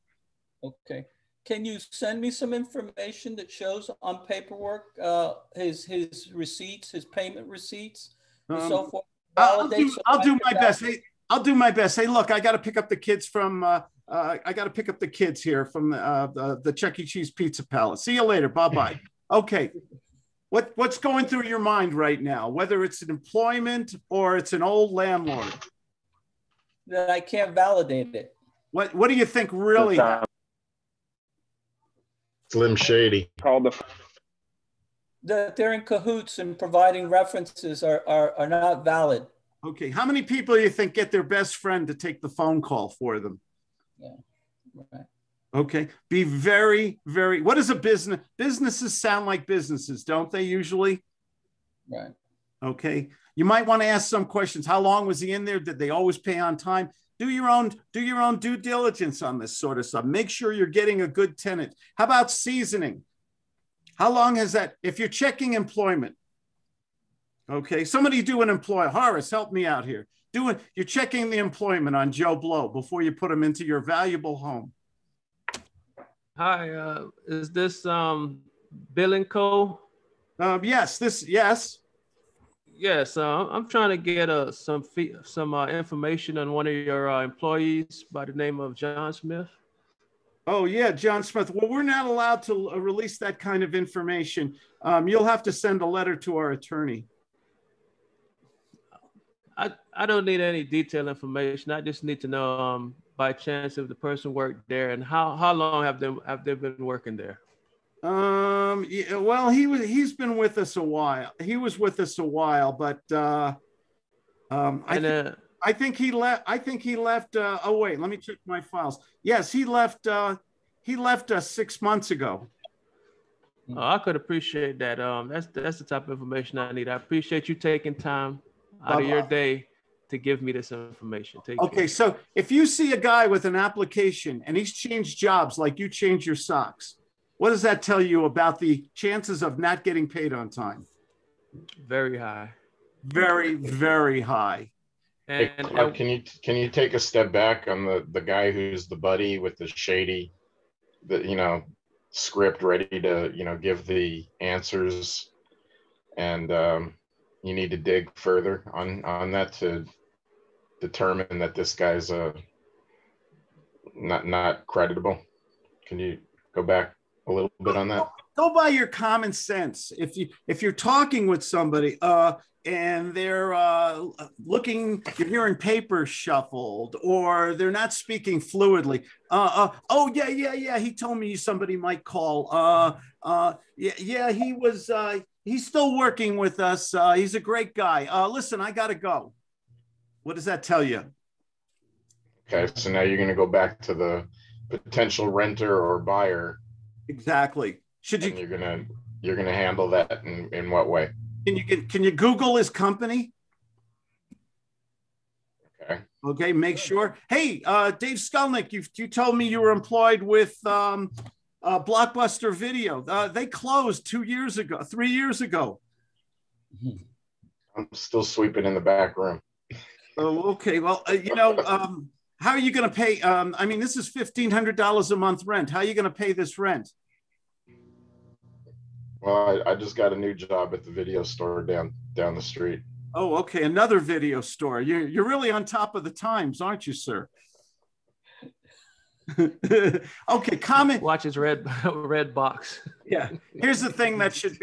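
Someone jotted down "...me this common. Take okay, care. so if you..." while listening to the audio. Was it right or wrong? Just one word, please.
wrong.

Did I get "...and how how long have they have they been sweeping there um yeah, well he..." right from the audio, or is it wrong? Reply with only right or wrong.
wrong.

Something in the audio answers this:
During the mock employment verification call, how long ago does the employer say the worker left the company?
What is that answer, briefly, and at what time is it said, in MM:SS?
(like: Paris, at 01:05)
6 months ago, at 02:01.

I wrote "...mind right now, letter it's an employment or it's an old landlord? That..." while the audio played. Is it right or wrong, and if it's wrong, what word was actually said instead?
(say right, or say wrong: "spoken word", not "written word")
wrong: "whether", not "letter".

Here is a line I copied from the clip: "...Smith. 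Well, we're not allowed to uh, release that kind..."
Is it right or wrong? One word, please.
right.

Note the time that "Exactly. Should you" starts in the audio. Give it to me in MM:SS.
03:17.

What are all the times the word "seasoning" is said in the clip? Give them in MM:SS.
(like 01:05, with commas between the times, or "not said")
01:02.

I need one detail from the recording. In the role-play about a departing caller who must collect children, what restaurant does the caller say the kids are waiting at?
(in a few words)
Chuck E. Cheese Pizza Palace.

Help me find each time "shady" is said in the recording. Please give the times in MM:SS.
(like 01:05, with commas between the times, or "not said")
00:32, 02:29.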